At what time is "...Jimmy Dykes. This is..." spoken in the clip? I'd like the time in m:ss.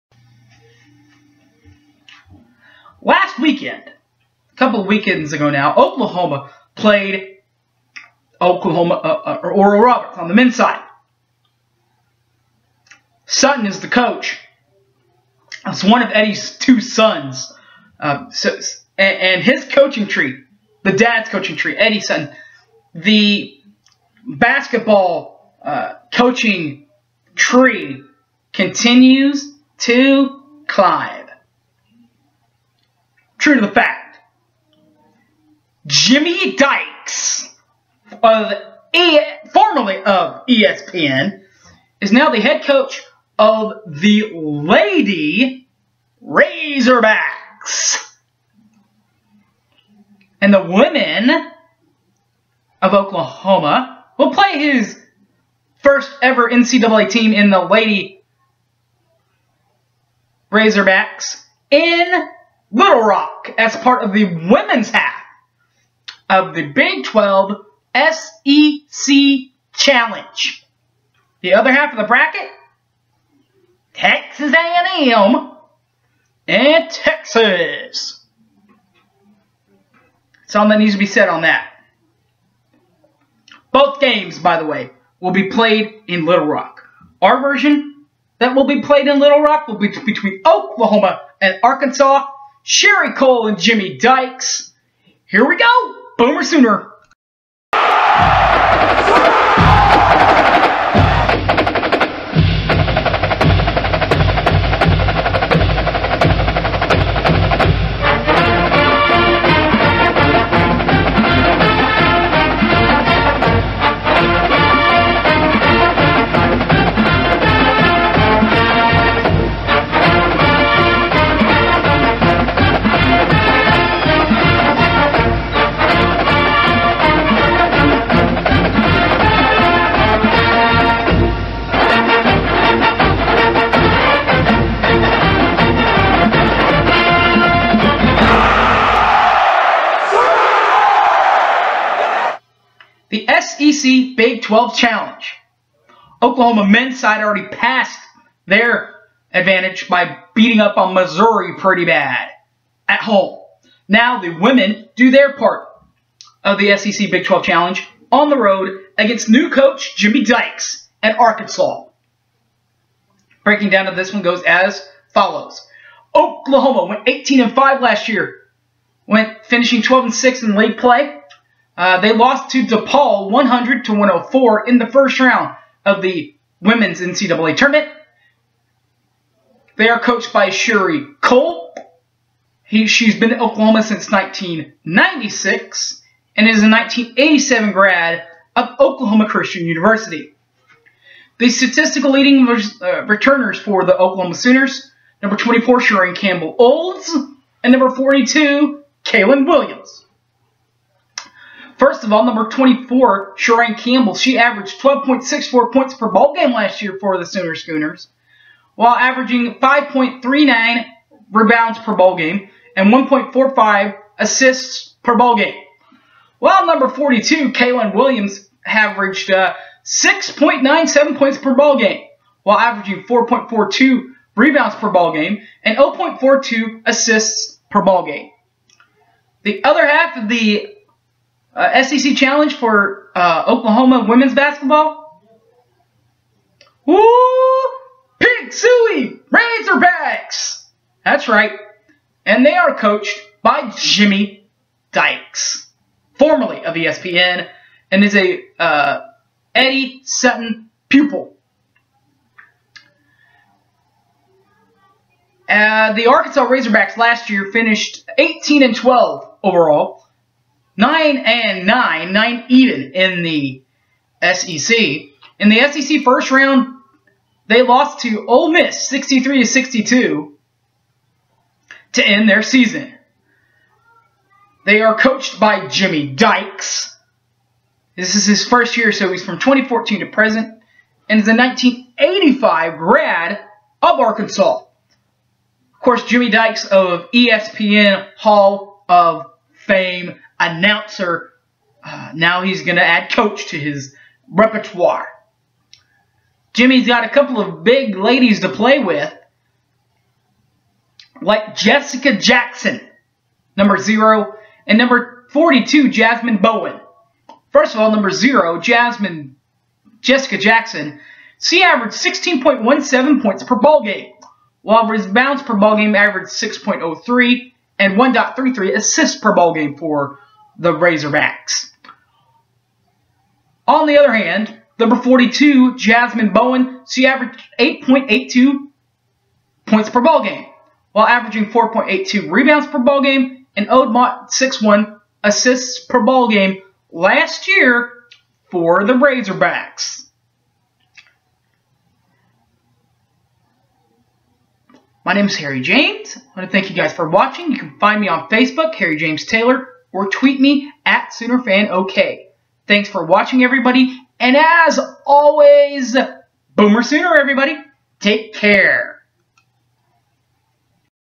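4:35.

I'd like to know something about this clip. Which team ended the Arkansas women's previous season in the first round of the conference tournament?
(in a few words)
Ole Miss.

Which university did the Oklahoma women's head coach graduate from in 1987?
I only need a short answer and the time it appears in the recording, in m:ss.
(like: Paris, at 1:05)
Oklahoma Christian University, at 3:08.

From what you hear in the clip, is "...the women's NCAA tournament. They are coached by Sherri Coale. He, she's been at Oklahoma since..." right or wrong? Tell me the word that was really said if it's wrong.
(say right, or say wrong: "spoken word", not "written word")
right.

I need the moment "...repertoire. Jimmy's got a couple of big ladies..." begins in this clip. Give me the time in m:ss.
4:54.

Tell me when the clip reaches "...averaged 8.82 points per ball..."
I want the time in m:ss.
5:27.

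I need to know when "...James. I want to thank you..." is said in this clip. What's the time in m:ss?
5:45.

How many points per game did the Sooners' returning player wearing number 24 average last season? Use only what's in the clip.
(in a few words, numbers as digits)
12.64.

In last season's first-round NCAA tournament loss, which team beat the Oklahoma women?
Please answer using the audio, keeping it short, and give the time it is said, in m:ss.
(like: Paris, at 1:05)
DePaul, at 2:52.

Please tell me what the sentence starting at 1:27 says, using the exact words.
Our version that will be played in Little Rock will be between Oklahoma and Arkansas Sherri Coale and Jimmy Dykes.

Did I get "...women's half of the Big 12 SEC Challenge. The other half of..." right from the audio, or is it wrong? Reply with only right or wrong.
right.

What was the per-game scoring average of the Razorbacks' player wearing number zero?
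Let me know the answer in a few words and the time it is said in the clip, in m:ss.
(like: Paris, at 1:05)
16.17, at 5:11.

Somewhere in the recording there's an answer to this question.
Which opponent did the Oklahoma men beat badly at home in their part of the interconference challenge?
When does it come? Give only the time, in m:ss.
2:30.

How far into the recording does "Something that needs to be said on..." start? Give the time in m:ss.
1:20.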